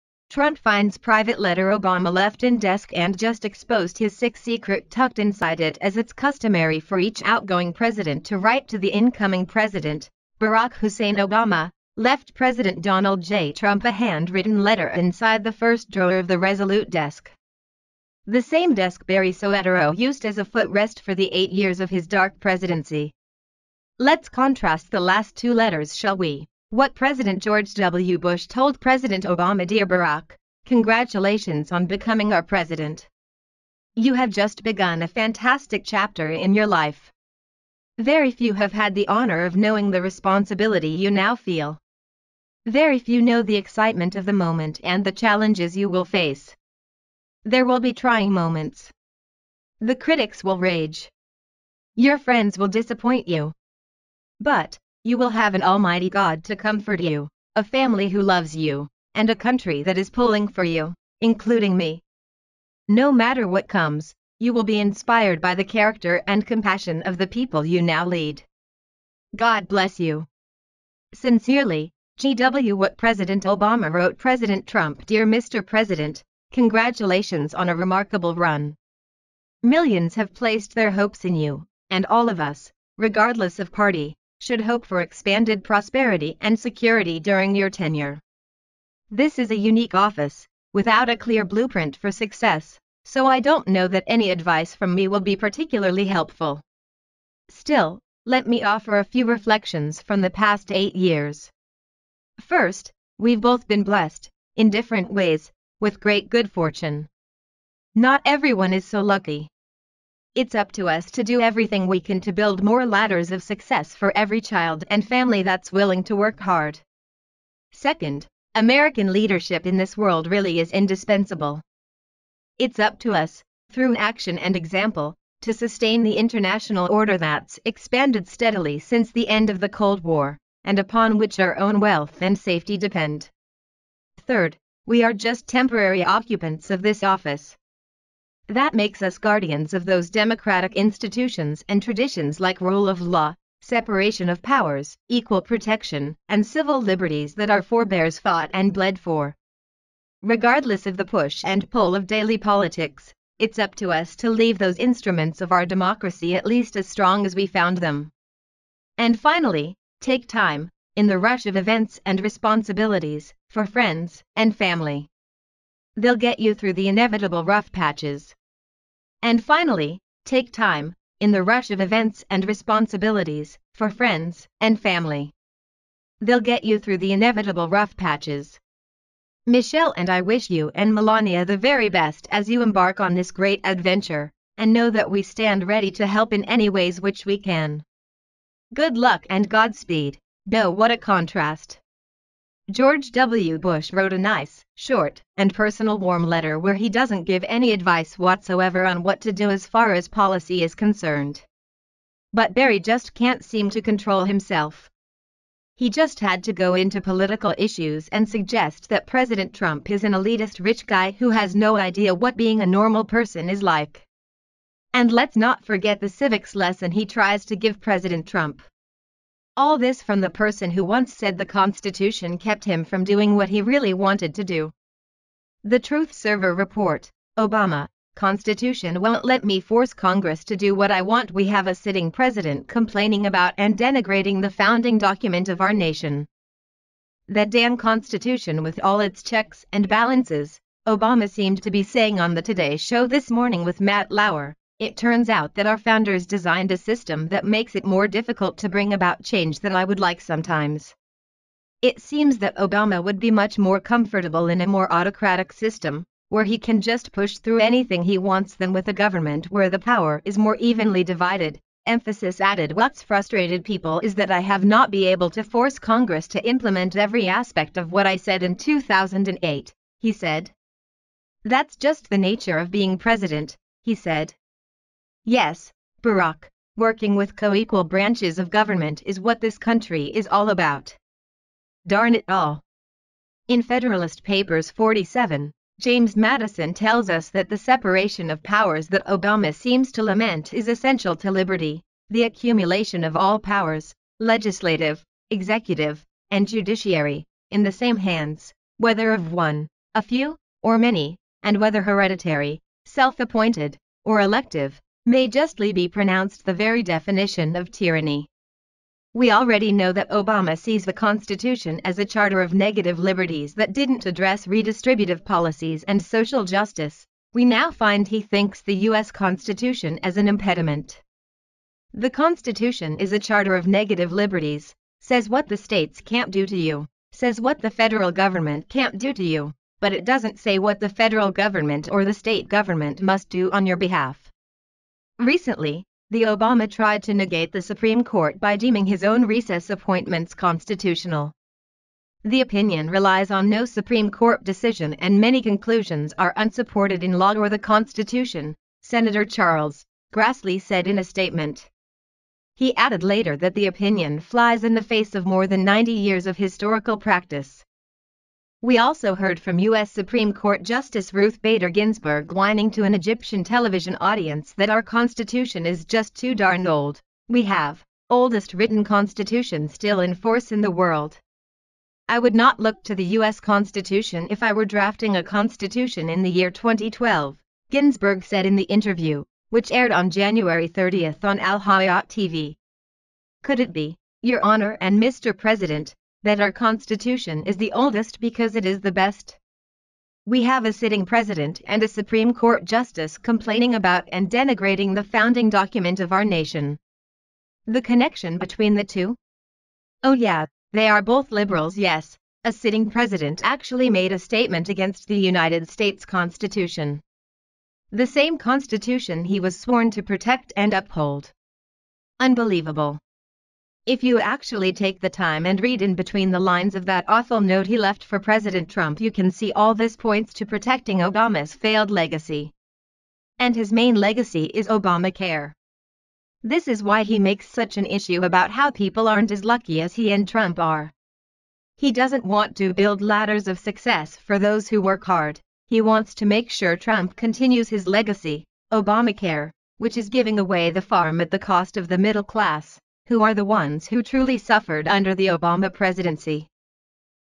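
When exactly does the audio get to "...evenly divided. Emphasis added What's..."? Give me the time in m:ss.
4:20.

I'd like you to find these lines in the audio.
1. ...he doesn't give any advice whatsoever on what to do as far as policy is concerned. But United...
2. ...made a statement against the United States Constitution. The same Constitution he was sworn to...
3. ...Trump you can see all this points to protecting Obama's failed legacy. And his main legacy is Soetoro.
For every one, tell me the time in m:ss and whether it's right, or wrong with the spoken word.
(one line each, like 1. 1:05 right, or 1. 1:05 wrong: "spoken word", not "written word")
1. 3:16 wrong: "Barry", not "United"
2. 6:43 right
3. 6:58 wrong: "Obamacare", not "Soetoro".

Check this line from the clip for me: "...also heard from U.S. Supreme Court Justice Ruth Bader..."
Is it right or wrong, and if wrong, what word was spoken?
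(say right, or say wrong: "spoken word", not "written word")
right.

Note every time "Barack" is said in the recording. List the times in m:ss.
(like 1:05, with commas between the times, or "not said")
0:10, 0:29, 4:36.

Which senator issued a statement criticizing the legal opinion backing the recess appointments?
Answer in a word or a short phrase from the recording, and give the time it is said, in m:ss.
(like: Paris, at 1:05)
Charles Grassley, at 5:49.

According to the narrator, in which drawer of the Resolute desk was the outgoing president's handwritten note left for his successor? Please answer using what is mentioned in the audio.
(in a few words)
First drawer.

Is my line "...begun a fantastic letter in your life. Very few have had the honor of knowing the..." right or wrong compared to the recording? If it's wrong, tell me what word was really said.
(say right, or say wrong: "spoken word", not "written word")
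wrong: "chapter", not "letter".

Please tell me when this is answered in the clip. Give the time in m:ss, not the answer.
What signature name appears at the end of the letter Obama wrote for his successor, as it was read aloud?
3:10.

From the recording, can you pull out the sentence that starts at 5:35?
Recently, the Obama tried to negate the Supreme Court by deeming his own recess appointments constitutional.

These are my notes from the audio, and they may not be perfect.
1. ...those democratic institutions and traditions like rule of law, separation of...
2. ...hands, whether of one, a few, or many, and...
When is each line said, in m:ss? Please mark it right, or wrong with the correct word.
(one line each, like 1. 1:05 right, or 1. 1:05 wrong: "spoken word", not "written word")
1. 2:19 right
2. 4:57 right.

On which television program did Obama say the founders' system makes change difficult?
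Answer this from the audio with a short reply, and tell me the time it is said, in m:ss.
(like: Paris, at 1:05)
Today Show, at 4:02.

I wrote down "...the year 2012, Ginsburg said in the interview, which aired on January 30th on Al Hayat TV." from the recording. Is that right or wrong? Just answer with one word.
right.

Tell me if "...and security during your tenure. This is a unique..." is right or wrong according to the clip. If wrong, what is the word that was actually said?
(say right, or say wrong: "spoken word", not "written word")
right.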